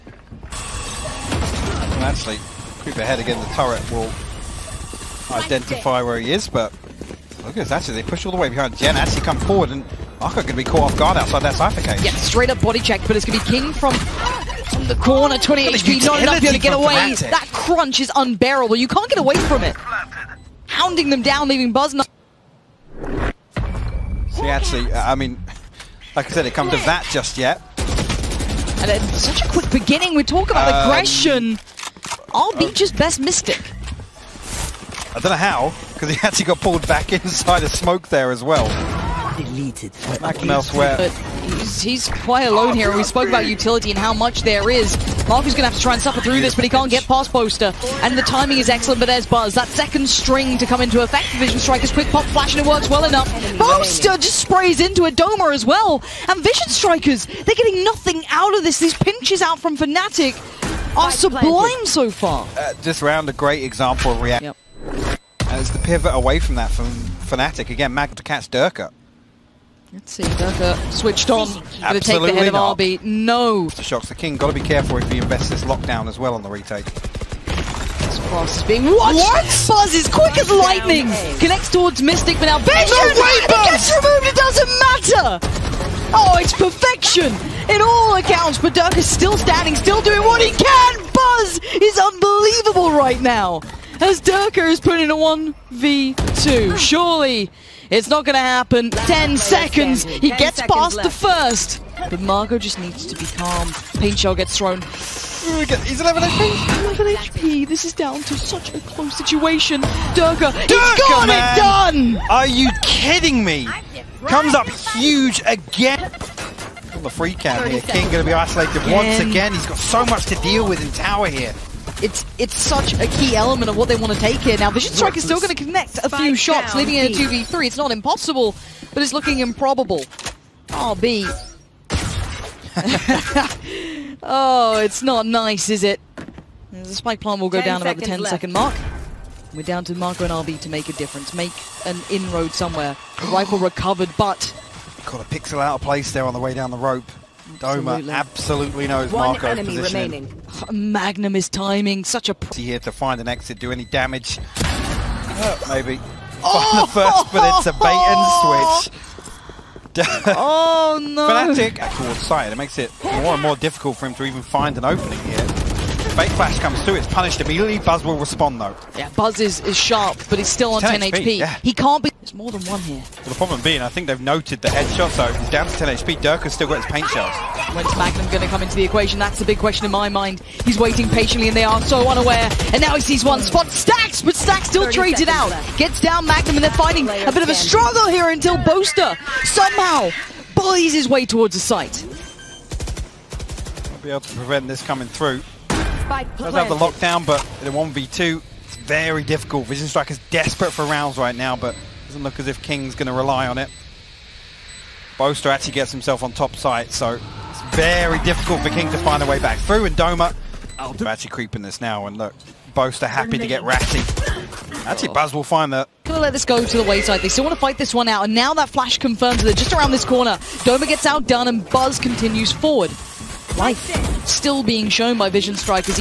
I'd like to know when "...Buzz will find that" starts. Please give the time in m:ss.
3:35.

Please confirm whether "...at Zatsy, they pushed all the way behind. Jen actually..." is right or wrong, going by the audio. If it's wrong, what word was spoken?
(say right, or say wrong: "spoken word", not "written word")
right.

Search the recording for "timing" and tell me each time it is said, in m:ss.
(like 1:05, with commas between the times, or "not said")
0:48, 2:31.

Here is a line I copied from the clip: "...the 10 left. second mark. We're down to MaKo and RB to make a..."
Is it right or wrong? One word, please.
right.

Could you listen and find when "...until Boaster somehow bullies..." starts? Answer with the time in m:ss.
3:08.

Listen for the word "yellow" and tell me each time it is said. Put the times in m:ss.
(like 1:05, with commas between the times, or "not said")
not said.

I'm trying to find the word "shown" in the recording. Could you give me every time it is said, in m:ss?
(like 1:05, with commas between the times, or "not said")
3:44.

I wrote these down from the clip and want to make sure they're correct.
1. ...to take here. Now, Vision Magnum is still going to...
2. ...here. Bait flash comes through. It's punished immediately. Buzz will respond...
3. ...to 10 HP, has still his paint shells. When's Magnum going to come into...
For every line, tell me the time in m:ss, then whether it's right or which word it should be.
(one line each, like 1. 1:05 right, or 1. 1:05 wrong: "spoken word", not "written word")
1. 2:04 wrong: "Strike", not "Magnum"
2. 2:45 right
3. 2:55 right.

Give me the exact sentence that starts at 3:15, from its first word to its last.
Does have the lockdown, but in 1v2, it's very difficult.